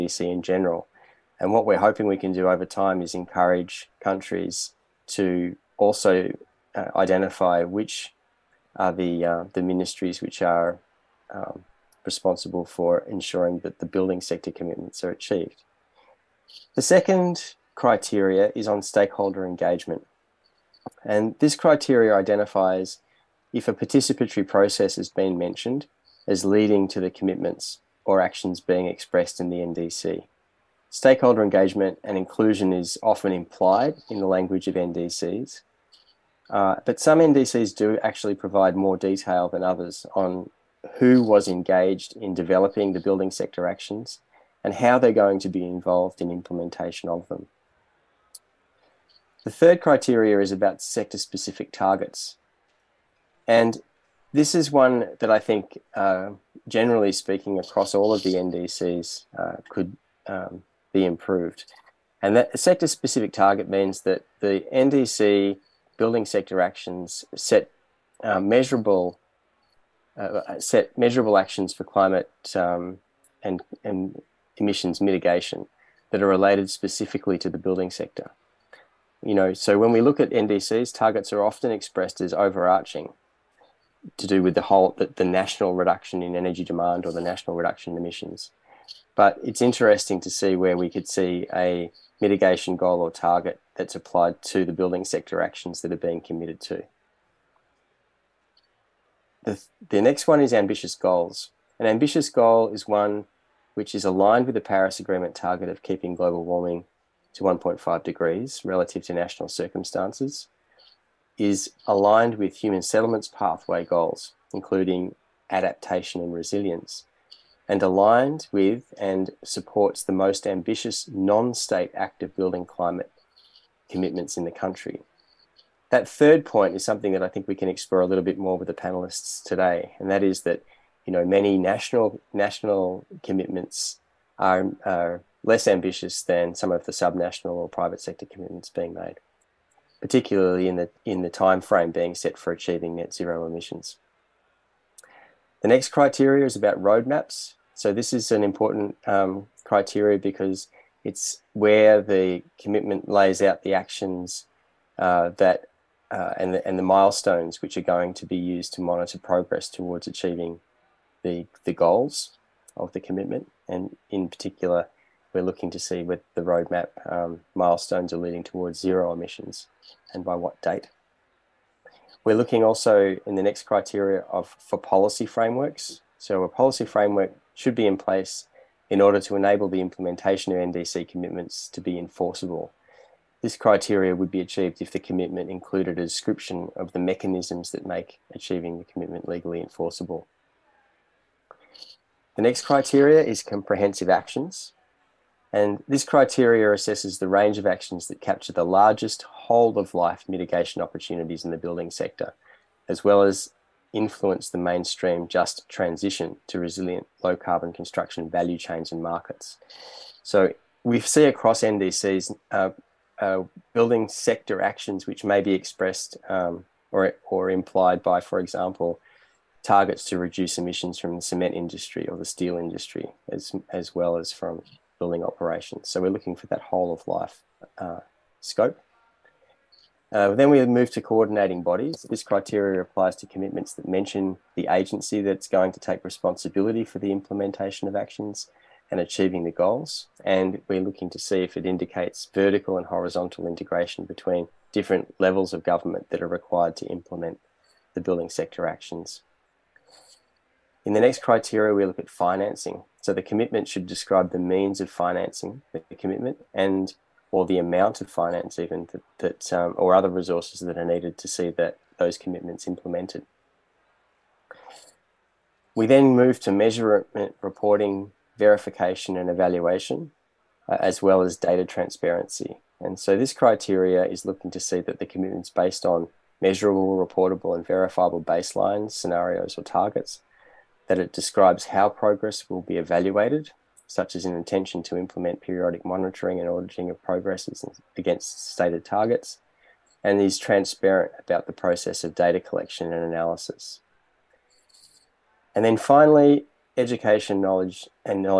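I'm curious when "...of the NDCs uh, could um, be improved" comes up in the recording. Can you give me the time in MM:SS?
00:58.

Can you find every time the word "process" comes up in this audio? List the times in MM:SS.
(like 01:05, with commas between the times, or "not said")
00:24, 04:51.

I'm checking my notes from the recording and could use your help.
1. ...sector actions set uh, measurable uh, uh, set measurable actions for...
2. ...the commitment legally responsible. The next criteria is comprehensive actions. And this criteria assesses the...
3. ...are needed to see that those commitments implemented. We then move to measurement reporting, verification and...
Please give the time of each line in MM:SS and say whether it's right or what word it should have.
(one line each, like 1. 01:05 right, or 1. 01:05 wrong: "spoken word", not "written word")
1. 01:06 right
2. 03:08 wrong: "enforceable", not "responsible"
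3. 04:20 right.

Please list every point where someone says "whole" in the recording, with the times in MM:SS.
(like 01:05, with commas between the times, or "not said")
01:24, 03:19, 03:46.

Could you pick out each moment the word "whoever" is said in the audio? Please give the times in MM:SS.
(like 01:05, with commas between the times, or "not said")
not said.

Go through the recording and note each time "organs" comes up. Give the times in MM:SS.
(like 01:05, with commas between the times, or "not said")
not said.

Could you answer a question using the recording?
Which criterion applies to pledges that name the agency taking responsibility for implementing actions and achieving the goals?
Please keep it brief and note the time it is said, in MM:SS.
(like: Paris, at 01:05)
Coordinating bodies, at 03:51.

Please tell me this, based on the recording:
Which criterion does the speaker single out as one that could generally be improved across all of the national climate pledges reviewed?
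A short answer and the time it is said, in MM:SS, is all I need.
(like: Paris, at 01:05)
Sector specific targets, at 00:50.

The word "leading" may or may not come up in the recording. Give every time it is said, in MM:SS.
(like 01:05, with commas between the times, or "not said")
00:26, 02:48.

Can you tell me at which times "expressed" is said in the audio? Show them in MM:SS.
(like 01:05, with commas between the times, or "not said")
00:28, 01:21, 03:35.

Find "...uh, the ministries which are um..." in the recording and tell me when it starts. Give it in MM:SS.
00:09.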